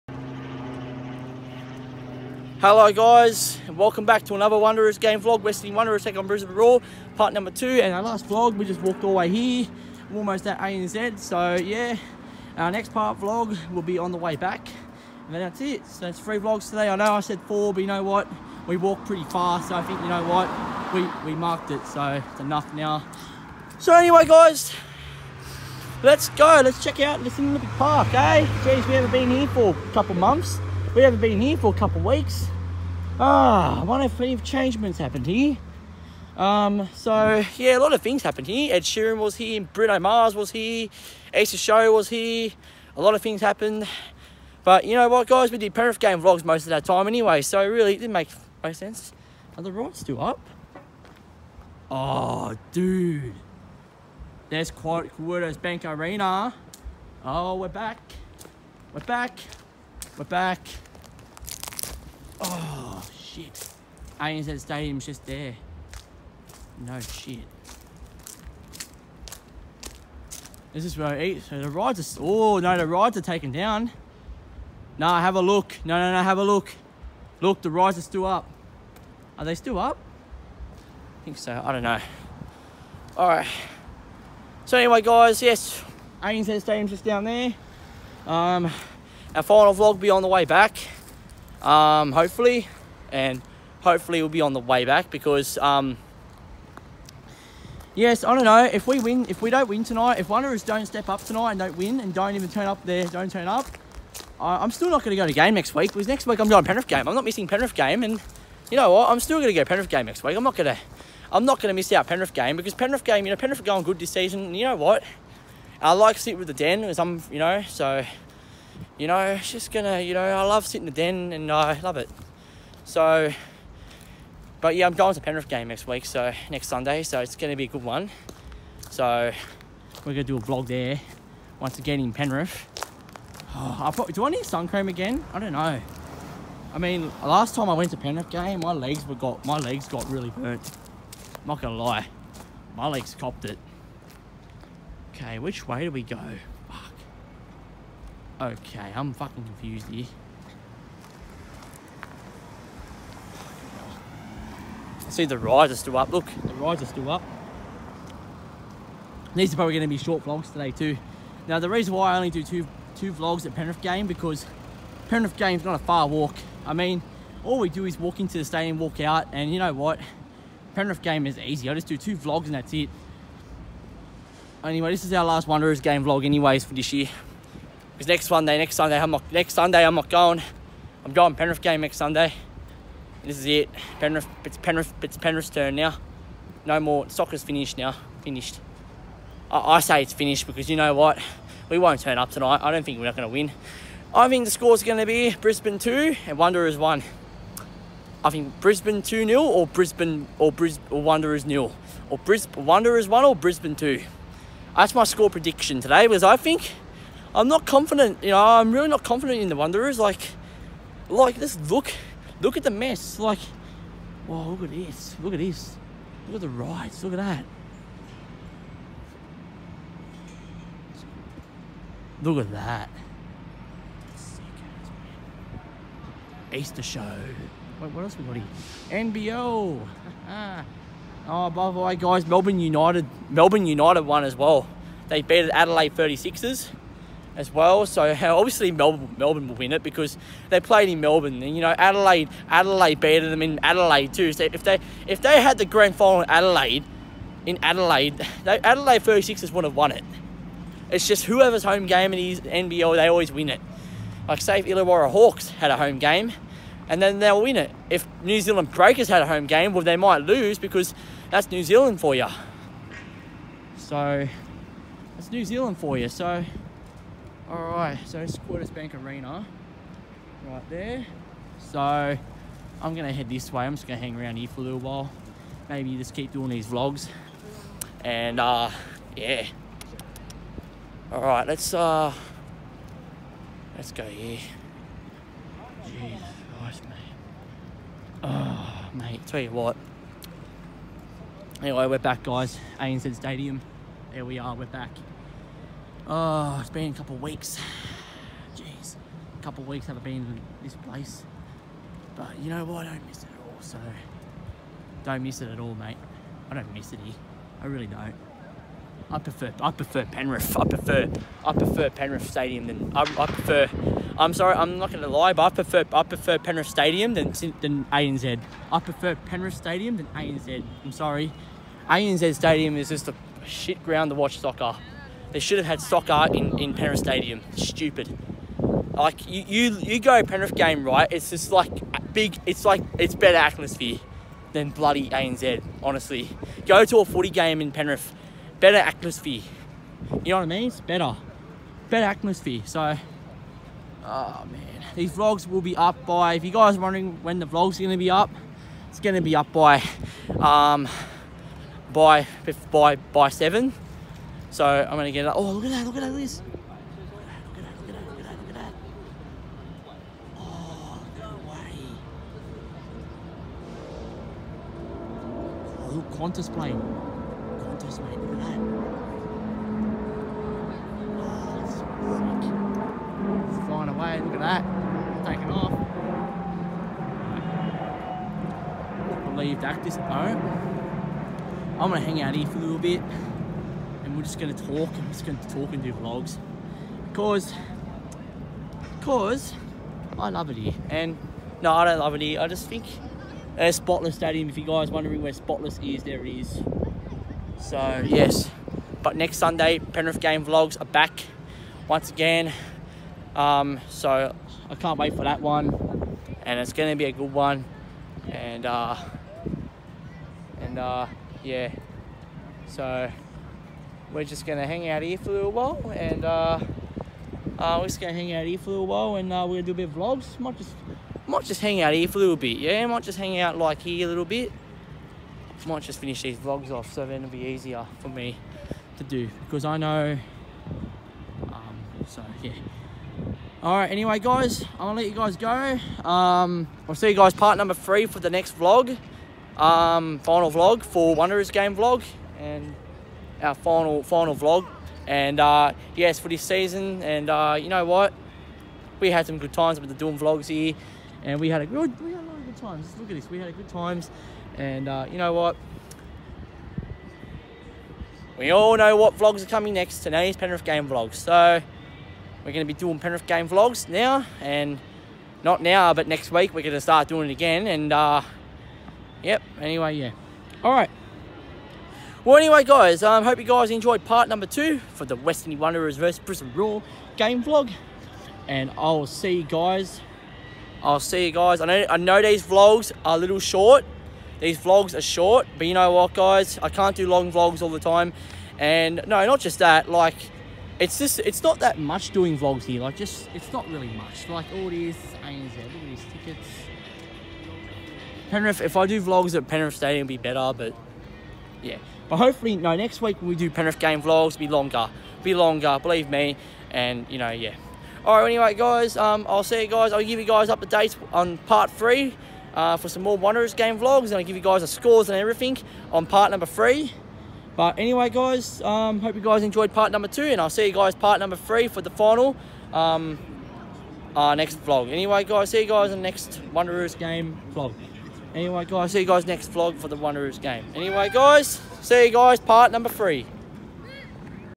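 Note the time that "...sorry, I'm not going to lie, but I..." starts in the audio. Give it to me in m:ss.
5:14.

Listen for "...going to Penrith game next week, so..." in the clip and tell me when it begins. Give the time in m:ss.
2:04.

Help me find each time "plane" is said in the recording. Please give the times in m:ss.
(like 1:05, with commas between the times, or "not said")
6:06.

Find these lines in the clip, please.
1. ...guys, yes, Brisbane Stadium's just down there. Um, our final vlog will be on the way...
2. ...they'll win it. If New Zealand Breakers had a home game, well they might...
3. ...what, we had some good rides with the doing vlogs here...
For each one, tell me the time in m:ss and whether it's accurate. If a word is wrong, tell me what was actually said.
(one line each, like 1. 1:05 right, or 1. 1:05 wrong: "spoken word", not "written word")
1. 1:25 wrong: "ANZ", not "Brisbane"
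2. 4:17 right
3. 7:27 wrong: "times", not "rides".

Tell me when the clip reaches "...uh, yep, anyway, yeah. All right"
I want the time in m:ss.
7:47.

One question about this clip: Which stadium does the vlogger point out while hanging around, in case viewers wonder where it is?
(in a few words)
Spotless Stadium.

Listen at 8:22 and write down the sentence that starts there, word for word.
But hopefully, no, next week when we do Penrith game vlogs, be longer, be longer, believe me.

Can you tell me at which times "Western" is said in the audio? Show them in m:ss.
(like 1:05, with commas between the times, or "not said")
0:05, 7:55.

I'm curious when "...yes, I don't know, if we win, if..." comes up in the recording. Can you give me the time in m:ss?
1:37.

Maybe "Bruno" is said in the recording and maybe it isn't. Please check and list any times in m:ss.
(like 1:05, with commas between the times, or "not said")
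0:39.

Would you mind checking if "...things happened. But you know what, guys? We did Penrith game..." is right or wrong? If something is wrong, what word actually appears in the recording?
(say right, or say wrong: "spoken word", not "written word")
right.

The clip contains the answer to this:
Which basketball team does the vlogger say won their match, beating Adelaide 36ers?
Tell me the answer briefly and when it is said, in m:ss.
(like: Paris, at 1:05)
Melbourne United, at 3:53.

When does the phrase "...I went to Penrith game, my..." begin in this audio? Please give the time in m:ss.
2:17.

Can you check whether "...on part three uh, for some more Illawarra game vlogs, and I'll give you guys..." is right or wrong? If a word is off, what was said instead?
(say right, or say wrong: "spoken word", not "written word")
wrong: "Wanderers", not "Illawarra".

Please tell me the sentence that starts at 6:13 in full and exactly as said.
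It's flying away, look at that.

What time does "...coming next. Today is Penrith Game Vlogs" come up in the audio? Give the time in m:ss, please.
7:39.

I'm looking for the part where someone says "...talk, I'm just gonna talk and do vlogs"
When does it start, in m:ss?
6:24.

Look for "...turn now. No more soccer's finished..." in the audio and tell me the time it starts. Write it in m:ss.
3:05.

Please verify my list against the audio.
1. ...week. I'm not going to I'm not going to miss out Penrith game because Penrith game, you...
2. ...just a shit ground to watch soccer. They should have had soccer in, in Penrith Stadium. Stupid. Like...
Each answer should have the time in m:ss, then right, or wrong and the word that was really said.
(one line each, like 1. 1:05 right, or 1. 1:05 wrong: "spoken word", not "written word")
1. 1:50 right
2. 5:22 right.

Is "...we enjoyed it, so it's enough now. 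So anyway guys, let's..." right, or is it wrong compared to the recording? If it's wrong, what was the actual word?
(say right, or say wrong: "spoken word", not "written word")
wrong: "marked", not "enjoyed".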